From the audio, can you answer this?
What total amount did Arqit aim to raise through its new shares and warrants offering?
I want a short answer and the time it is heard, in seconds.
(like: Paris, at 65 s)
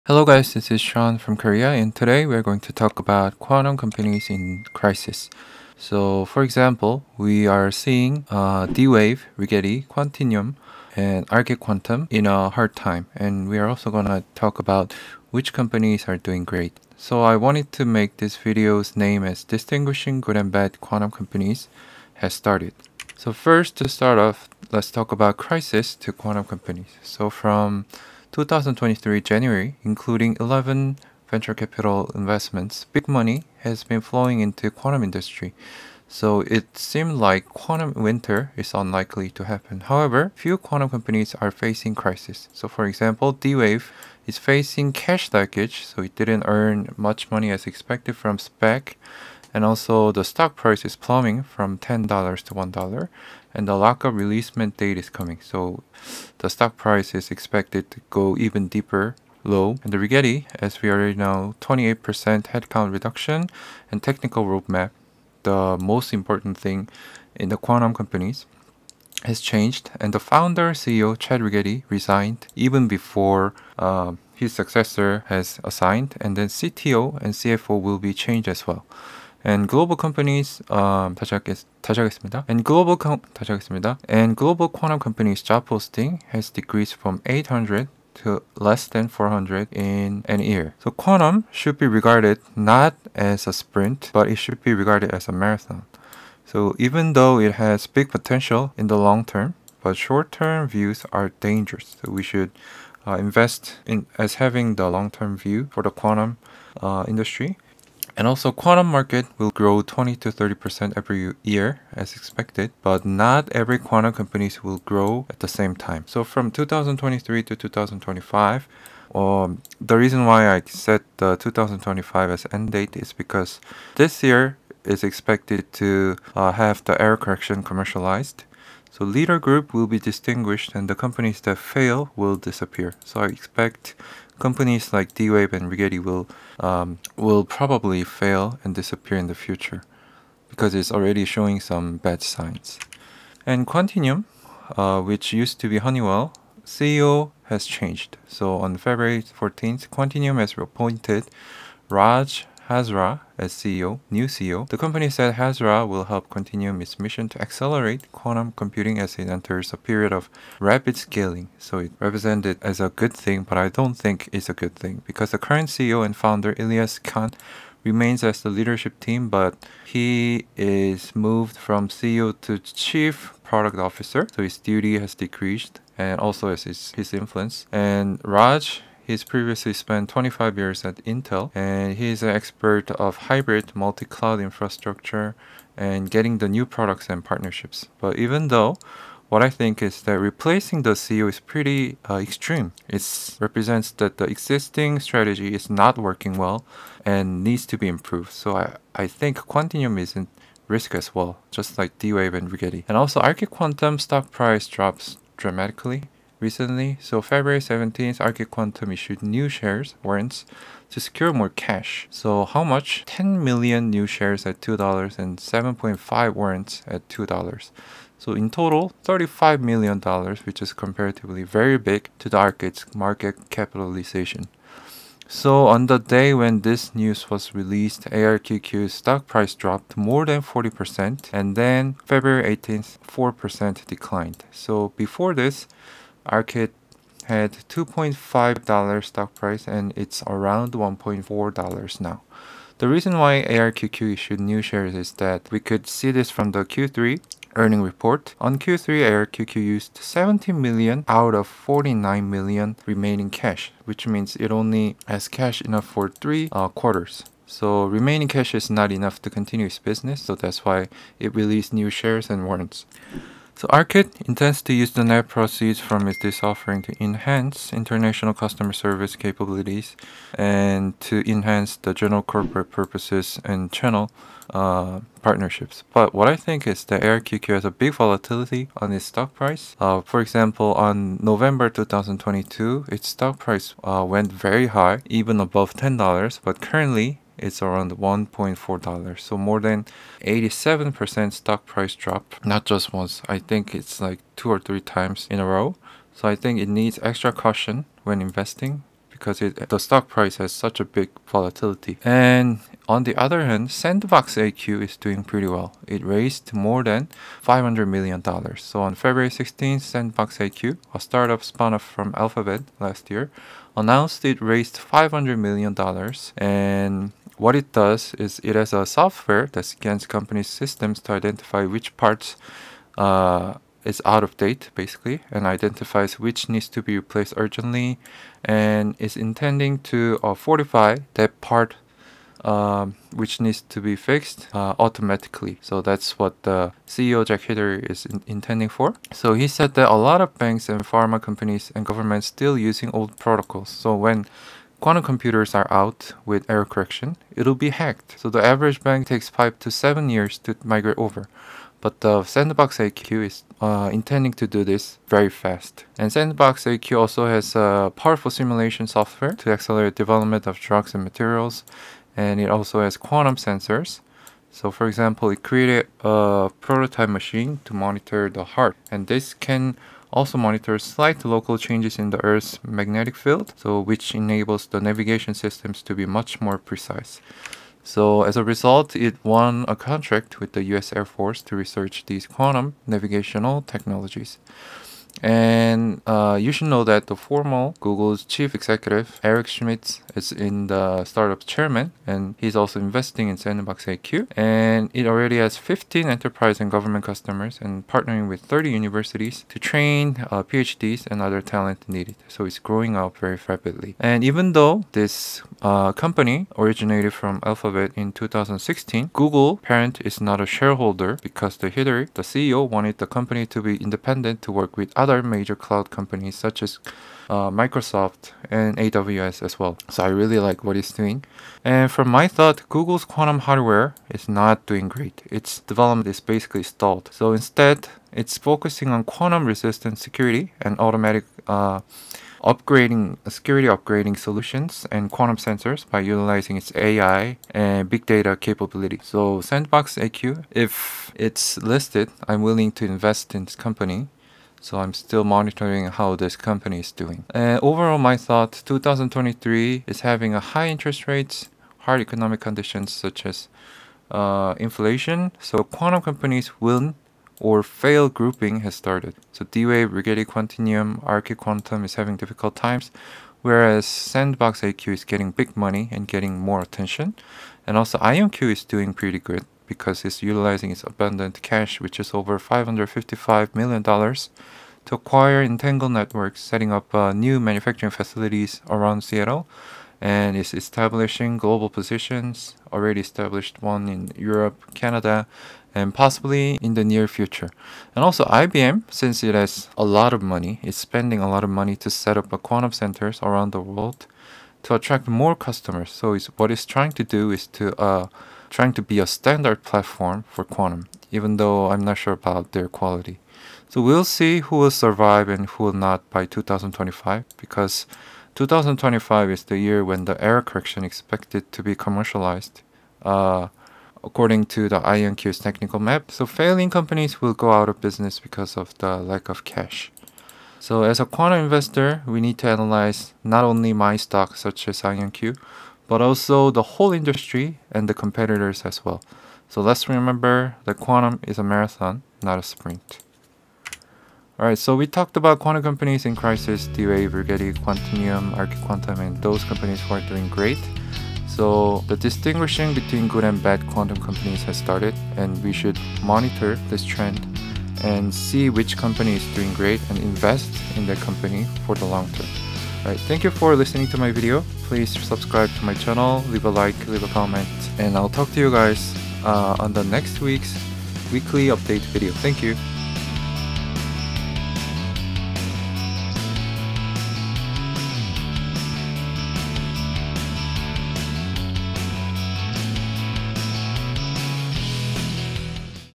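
$35 million, at 219 s.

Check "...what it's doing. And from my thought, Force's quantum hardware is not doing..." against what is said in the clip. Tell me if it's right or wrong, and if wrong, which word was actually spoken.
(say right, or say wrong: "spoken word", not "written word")
wrong: "Google", not "Force".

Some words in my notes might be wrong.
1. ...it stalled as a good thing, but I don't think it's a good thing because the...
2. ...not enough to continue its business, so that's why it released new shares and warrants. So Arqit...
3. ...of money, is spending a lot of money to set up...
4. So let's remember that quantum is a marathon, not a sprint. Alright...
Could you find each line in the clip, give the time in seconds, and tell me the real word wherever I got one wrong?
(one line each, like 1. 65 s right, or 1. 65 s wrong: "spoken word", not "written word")
1. 161 s wrong: "represented", not "stalled"
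2. 258 s right
3. 490 s right
4. 529 s right.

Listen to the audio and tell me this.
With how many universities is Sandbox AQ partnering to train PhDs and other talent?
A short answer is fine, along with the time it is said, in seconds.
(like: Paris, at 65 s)
30, at 398 s.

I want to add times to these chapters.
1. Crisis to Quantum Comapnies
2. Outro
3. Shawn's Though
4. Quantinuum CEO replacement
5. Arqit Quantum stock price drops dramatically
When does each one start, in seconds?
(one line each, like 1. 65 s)
1. 23 s
2. 533 s
3. 447 s
4. 143 s
5. 203 s.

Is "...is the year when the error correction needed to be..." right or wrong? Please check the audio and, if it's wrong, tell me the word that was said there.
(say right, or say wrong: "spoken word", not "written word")
wrong: "expected", not "needed".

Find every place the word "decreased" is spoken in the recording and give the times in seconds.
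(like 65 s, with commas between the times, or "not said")
86 s, 175 s.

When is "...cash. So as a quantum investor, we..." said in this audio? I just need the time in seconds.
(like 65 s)
519 s.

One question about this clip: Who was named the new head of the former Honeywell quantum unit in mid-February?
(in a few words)
Raj Hazra.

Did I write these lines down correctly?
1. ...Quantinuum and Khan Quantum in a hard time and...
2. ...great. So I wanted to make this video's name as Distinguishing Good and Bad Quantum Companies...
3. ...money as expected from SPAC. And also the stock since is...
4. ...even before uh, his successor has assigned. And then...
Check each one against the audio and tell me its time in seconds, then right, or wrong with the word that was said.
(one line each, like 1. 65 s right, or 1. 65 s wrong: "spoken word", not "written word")
1. 9 s wrong: "Arqit", not "Khan"
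2. 16 s right
3. 47 s wrong: "price", not "since"
4. 72 s right.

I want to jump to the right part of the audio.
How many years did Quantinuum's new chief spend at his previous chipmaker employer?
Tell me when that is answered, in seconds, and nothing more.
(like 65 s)
180 s.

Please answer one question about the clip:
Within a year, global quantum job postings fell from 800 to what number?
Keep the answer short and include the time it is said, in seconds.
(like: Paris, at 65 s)
less than 400, at 88 s.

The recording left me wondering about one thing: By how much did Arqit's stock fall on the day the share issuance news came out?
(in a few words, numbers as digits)
more than 40%.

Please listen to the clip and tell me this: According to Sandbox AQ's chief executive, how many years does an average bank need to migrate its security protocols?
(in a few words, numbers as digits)
5 to 7 years.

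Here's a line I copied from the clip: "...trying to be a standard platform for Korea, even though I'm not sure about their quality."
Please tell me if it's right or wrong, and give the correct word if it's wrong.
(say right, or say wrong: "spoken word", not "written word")
wrong: "Quantum", not "Korea".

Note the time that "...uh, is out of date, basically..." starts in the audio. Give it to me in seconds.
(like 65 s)
322 s.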